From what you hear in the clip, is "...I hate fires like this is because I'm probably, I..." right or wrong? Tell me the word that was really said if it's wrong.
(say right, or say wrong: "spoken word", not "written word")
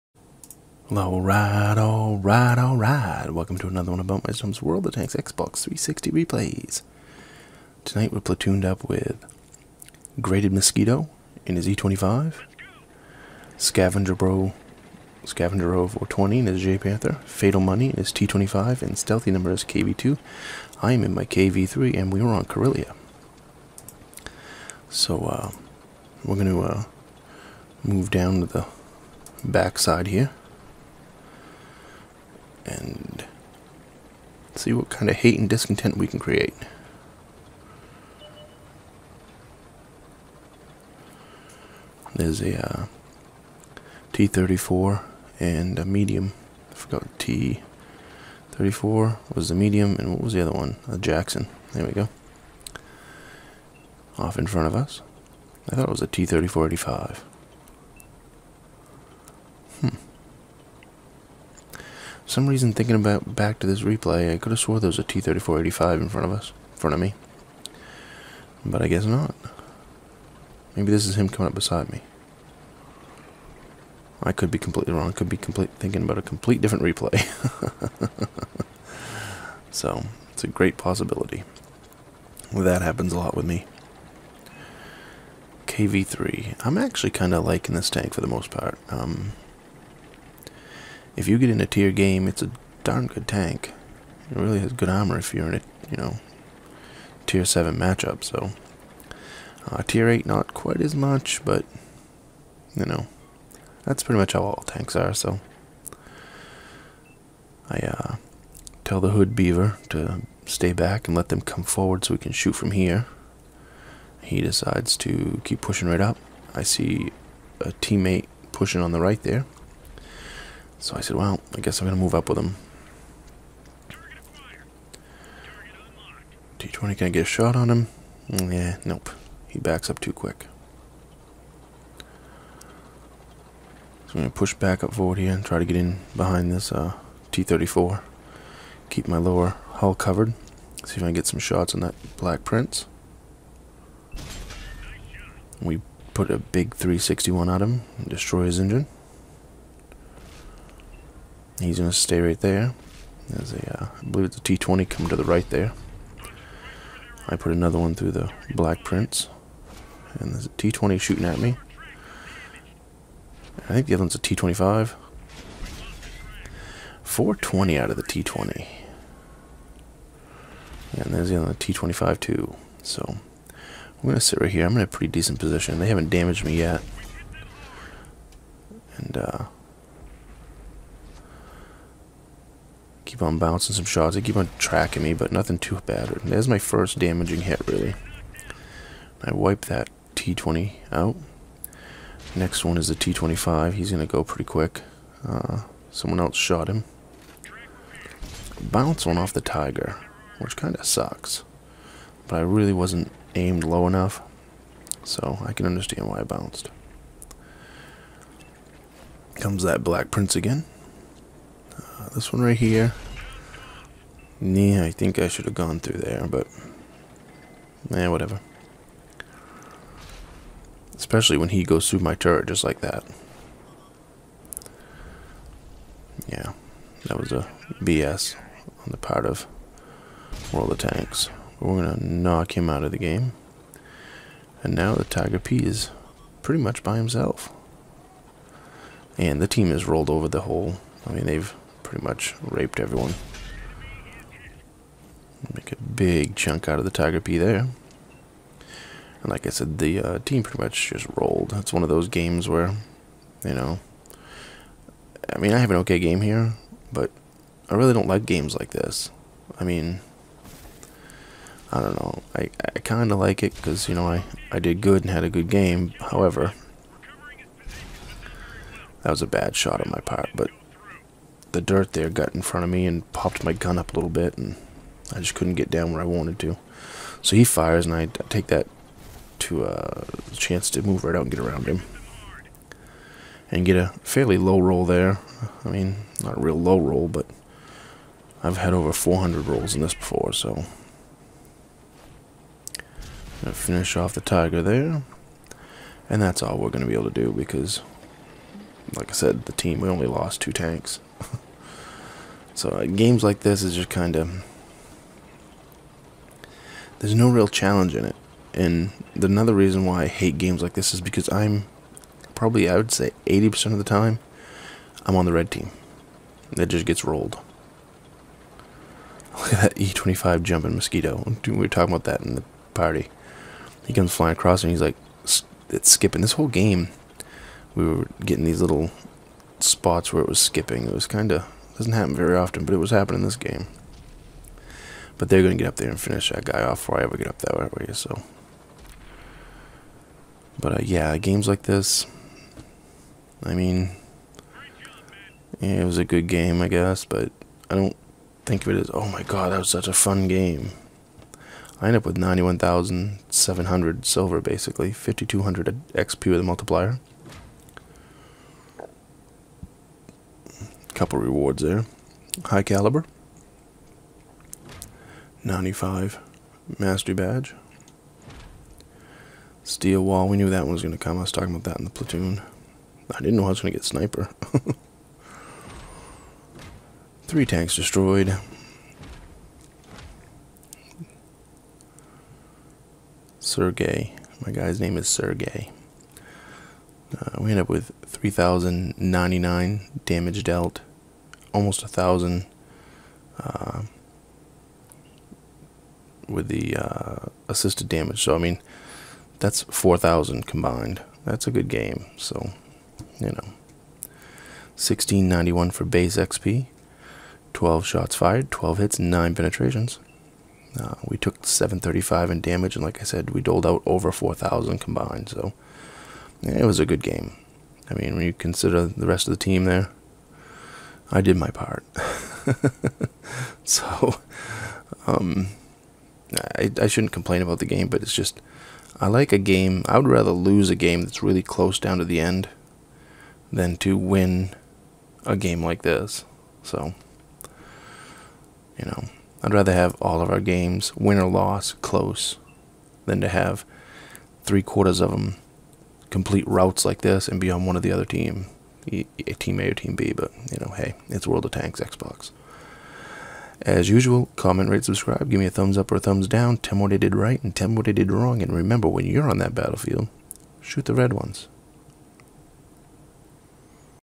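wrong: "games", not "fires".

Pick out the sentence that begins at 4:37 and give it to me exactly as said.
So he fires, and I take that to a uh, chance to move right out and get around him.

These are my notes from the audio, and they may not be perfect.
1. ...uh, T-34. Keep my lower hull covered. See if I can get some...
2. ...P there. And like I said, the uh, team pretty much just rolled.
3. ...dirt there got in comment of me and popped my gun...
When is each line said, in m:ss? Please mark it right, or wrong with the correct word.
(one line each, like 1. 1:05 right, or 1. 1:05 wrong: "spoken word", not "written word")
1. 2:16 right
2. 4:07 right
3. 4:31 wrong: "front", not "comment".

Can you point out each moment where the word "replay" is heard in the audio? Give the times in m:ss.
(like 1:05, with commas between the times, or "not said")
0:06, 1:03, 1:16.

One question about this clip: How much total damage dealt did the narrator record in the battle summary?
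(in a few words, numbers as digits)
3,099.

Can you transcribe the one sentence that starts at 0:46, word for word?
I forgot T34 was the medium, and what was the other one?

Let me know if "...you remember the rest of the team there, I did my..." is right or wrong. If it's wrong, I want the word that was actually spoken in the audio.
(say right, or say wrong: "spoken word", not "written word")
wrong: "consider", not "remember".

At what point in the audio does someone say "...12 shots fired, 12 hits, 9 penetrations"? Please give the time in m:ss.
6:47.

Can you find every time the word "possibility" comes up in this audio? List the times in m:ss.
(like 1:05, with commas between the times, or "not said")
1:20.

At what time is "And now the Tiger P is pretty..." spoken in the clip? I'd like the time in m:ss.
3:54.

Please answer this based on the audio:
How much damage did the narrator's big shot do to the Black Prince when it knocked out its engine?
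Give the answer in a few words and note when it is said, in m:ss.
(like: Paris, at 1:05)
361, at 2:26.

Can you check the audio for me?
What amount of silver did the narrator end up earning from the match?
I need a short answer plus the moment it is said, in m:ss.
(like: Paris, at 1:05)
91,700, at 5:52.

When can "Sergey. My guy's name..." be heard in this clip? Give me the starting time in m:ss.
6:23.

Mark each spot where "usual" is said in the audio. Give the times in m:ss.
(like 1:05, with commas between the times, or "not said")
7:33.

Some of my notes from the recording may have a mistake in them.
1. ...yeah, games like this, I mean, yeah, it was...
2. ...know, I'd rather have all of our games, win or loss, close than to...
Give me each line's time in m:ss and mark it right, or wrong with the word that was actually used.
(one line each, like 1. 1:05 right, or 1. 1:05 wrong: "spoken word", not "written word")
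1. 5:40 right
2. 7:18 right.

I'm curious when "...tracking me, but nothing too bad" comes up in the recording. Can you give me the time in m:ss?
3:04.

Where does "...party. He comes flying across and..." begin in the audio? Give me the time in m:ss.
5:22.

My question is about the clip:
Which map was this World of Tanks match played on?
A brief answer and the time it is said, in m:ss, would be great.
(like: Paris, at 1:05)
Karelia, at 0:22.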